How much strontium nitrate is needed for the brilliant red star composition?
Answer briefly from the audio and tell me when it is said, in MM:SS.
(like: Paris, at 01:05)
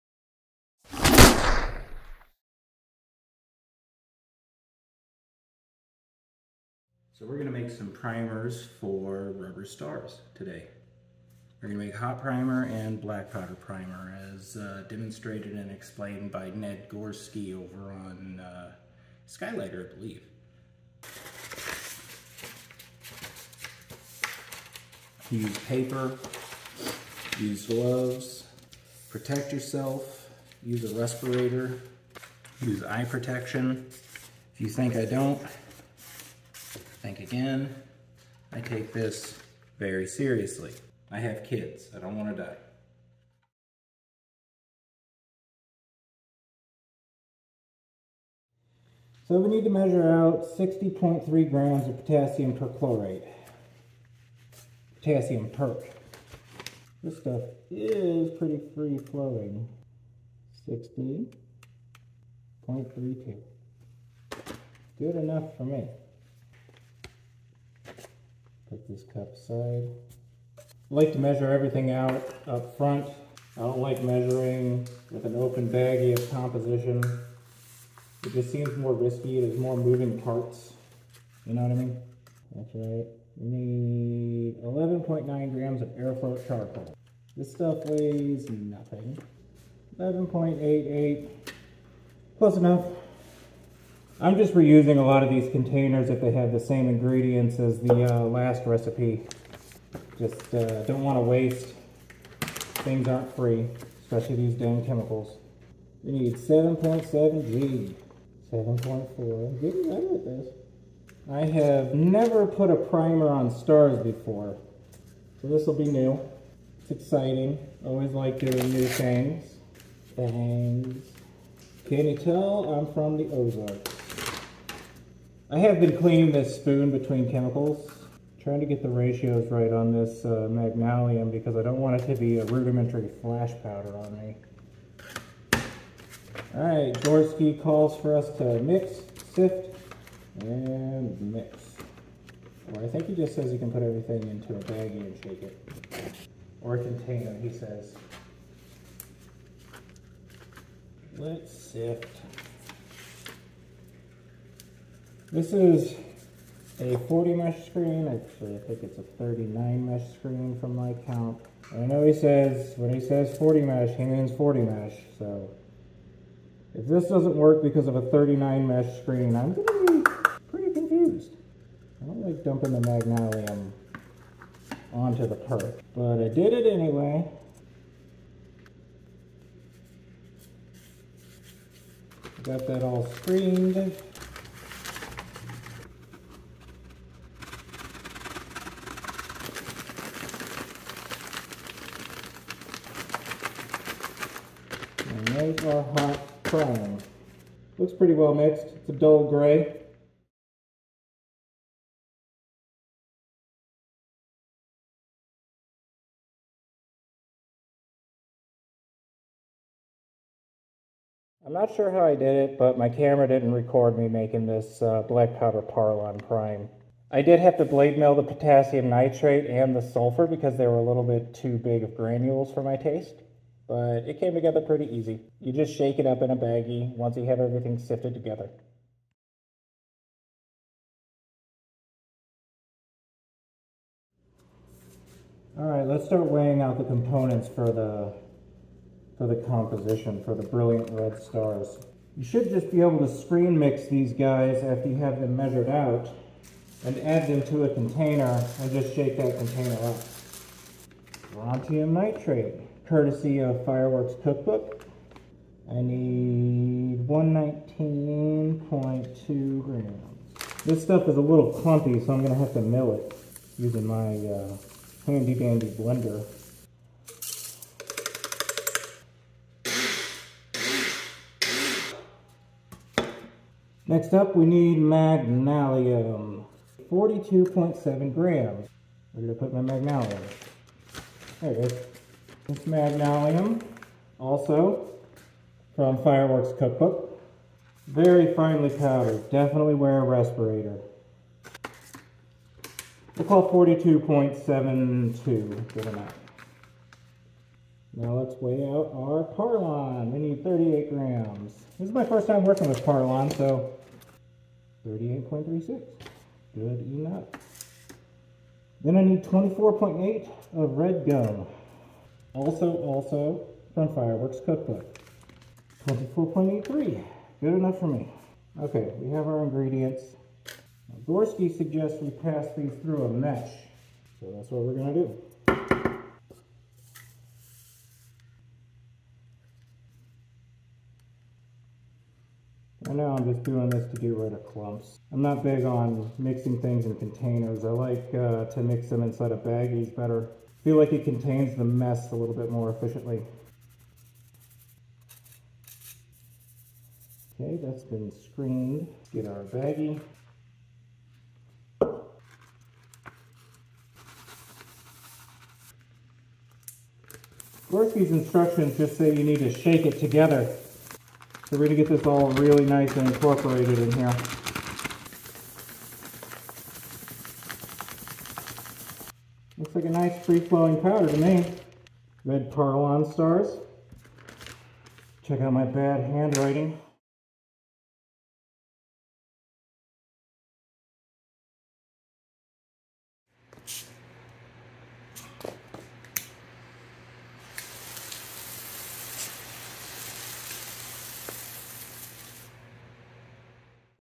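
119.2 grams, at 04:17.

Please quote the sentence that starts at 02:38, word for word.
Actually, I think it's a 39 mesh screen from my count.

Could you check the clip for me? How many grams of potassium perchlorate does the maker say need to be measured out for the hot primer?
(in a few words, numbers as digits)
60.3 grams.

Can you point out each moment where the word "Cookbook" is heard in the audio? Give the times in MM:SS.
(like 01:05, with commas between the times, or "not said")
04:14, 04:46, 05:14.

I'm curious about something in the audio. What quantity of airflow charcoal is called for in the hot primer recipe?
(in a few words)
11.9 grams.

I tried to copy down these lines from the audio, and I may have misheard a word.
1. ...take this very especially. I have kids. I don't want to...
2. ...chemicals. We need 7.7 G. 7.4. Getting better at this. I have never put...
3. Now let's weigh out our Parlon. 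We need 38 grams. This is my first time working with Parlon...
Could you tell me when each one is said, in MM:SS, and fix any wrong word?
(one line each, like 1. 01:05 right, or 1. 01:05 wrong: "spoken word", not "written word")
1. 00:38 wrong: "seriously", not "especially"
2. 01:44 right
3. 04:57 right.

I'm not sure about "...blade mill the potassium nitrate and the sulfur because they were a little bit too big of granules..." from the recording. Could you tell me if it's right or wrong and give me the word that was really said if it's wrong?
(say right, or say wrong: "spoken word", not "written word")
right.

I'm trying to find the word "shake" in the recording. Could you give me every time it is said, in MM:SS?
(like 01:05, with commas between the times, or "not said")
02:25, 03:45, 04:08, 05:59.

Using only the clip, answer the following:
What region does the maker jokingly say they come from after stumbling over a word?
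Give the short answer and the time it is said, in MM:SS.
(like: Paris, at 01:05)
the Ozarks, at 02:03.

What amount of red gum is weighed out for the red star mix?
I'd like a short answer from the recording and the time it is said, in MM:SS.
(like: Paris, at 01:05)
24.8 grams, at 05:09.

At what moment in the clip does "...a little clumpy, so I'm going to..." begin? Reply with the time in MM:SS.
04:21.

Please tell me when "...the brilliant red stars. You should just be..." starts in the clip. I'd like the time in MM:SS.
04:00.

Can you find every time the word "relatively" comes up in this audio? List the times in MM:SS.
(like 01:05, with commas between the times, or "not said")
not said.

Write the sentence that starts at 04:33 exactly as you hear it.
Next up, we need Magnalium, 42.7 grams.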